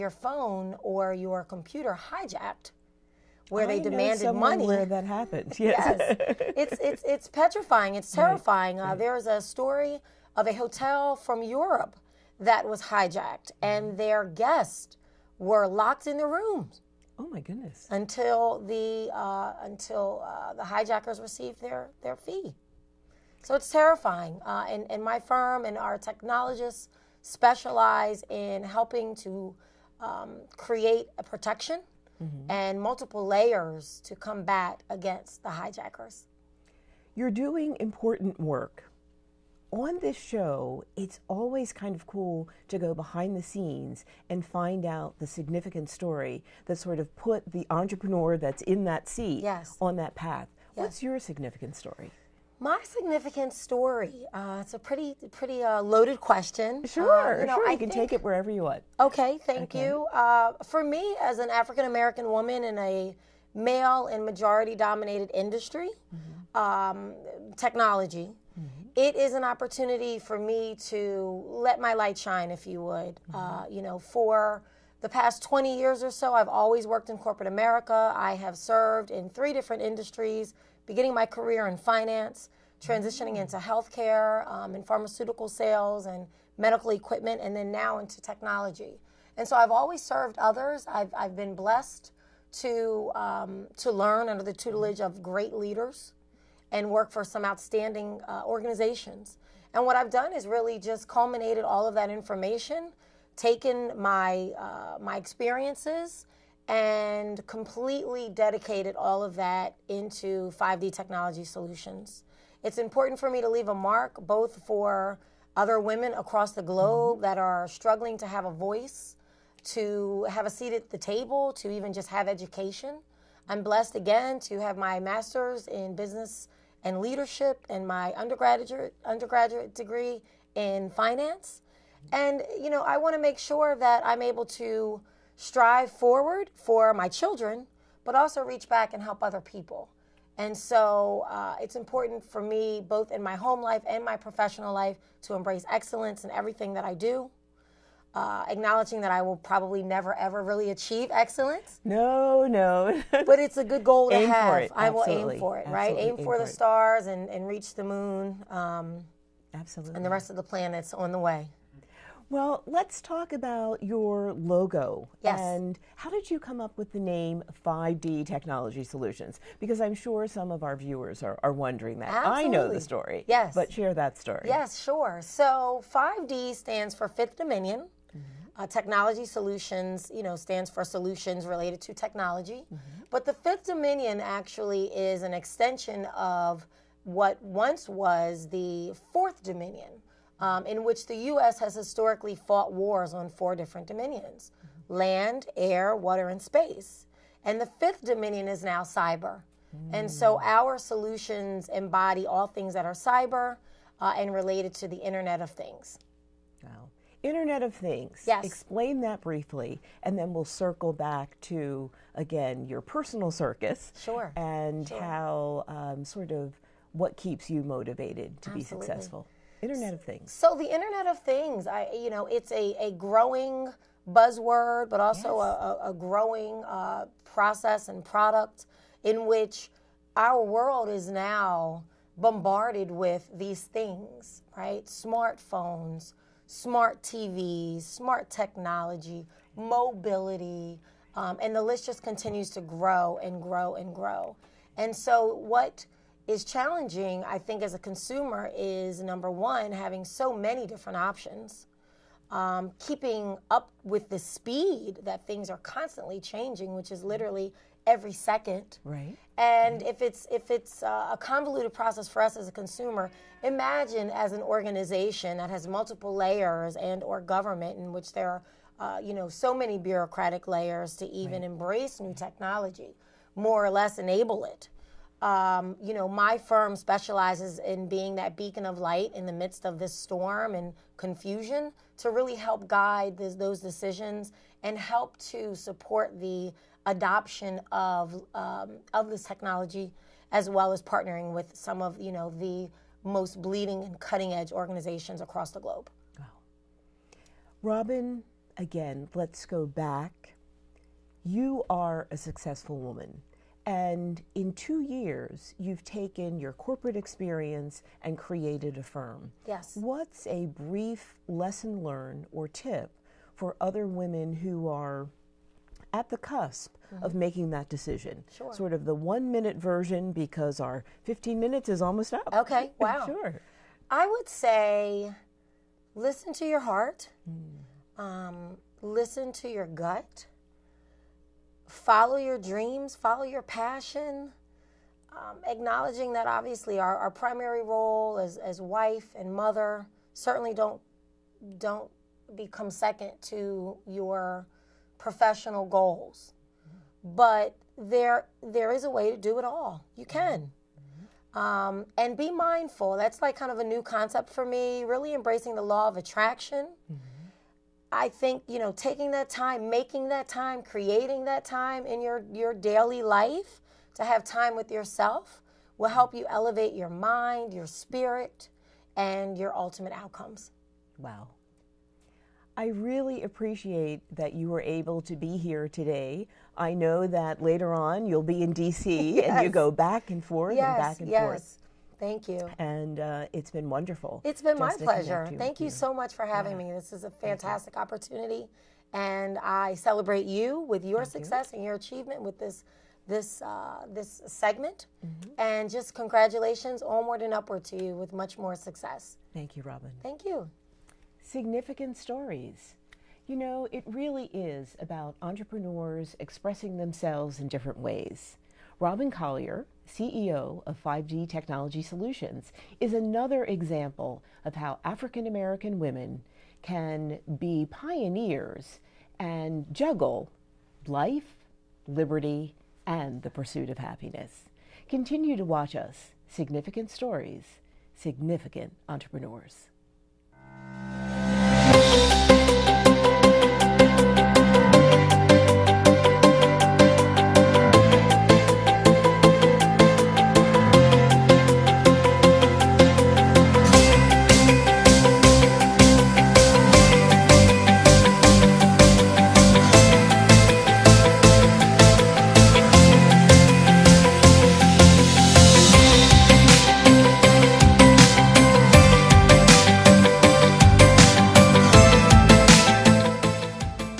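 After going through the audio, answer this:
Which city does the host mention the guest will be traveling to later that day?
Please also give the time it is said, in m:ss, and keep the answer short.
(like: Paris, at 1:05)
DC, at 6:18.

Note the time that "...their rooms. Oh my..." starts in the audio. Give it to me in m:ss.
0:16.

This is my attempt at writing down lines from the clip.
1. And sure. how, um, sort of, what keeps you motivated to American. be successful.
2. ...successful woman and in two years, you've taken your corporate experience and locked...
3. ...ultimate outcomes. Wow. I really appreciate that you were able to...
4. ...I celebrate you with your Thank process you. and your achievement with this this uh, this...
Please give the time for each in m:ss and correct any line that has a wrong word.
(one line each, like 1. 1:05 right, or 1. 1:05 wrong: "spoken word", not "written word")
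1. 3:34 wrong: "Absolutely", not "American"
2. 5:02 wrong: "created", not "locked"
3. 6:09 right
4. 6:29 wrong: "success", not "process".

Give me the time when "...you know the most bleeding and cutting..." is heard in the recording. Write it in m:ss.
4:51.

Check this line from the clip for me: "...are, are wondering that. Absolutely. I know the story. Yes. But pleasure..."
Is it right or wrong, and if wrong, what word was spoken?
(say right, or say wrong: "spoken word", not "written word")
wrong: "share", not "pleasure".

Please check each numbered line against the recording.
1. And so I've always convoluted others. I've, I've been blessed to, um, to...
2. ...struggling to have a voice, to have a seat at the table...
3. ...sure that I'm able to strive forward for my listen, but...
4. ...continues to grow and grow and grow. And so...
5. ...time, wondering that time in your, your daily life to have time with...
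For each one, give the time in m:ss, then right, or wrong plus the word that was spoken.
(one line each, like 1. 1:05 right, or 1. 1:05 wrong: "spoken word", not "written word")
1. 1:29 wrong: "served", not "convoluted"
2. 1:57 right
3. 2:13 wrong: "children", not "listen"
4. 4:02 right
5. 6:00 wrong: "creating", not "wondering".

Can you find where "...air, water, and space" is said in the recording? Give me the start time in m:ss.
3:15.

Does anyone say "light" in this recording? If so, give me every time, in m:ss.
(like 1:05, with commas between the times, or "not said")
1:11, 4:38.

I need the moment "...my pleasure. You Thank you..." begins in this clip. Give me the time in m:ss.
6:24.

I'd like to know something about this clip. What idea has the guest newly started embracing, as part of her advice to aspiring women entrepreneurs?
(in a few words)
law of attraction.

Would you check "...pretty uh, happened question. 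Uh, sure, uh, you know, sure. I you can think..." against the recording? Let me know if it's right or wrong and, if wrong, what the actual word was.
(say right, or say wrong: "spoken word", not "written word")
wrong: "loaded", not "happened".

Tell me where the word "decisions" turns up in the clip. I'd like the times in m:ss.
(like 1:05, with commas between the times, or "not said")
4:43, 5:17.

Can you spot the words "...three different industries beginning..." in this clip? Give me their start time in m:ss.
1:19.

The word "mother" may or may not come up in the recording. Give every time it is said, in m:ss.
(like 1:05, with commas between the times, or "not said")
5:39.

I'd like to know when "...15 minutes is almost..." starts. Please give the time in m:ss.
5:21.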